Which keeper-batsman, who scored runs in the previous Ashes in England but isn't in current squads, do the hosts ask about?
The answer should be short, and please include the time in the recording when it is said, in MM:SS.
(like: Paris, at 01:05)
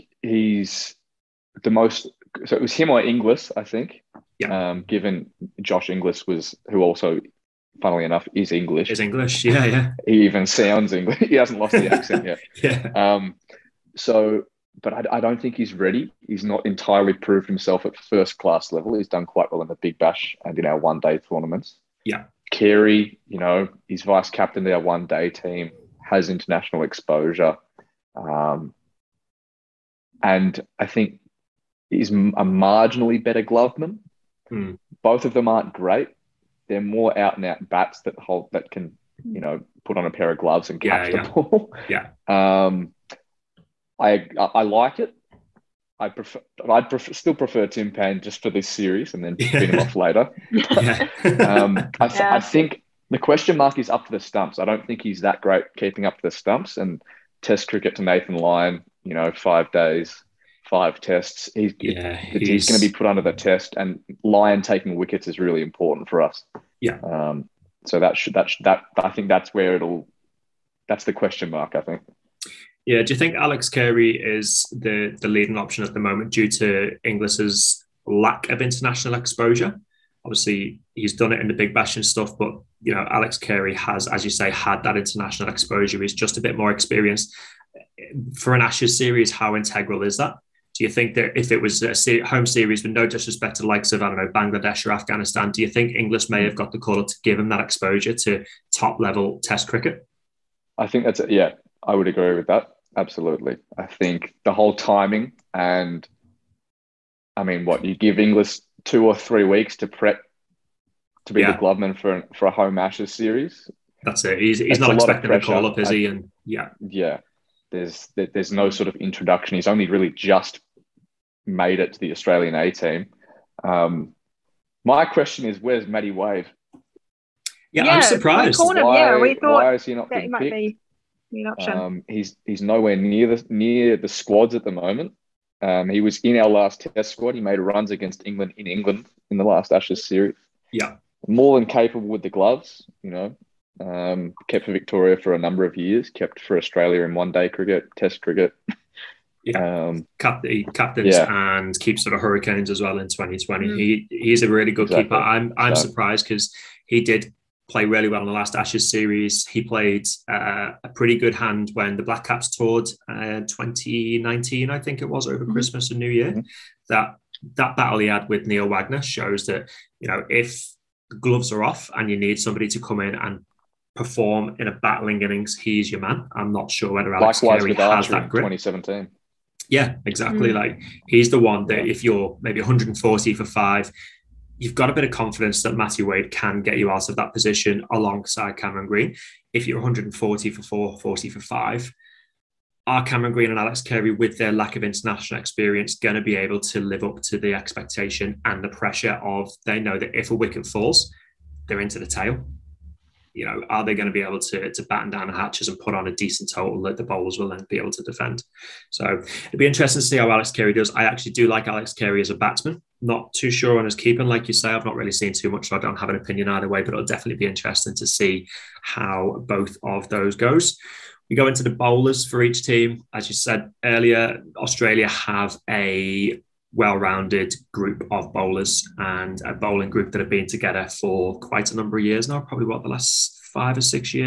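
Matty Wade, at 02:05.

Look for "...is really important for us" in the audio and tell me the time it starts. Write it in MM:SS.
01:05.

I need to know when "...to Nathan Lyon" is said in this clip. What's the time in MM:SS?
00:57.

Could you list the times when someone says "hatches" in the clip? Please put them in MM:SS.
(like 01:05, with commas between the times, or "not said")
03:25.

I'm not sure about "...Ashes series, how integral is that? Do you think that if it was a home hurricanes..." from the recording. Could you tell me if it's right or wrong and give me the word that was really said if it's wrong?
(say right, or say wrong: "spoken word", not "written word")
wrong: "series", not "hurricanes".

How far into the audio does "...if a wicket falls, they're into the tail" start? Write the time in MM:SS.
03:20.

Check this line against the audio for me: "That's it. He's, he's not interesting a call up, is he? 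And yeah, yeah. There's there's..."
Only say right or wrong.
wrong.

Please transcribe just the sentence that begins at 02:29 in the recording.
Yeah, um, cap, he captains yeah.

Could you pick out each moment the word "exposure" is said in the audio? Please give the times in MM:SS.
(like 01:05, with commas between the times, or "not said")
00:26, 01:19, 01:25, 01:37.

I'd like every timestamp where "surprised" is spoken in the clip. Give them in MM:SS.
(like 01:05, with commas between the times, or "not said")
02:08, 02:35.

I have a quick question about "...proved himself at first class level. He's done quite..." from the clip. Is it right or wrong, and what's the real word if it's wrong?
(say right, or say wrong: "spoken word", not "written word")
right.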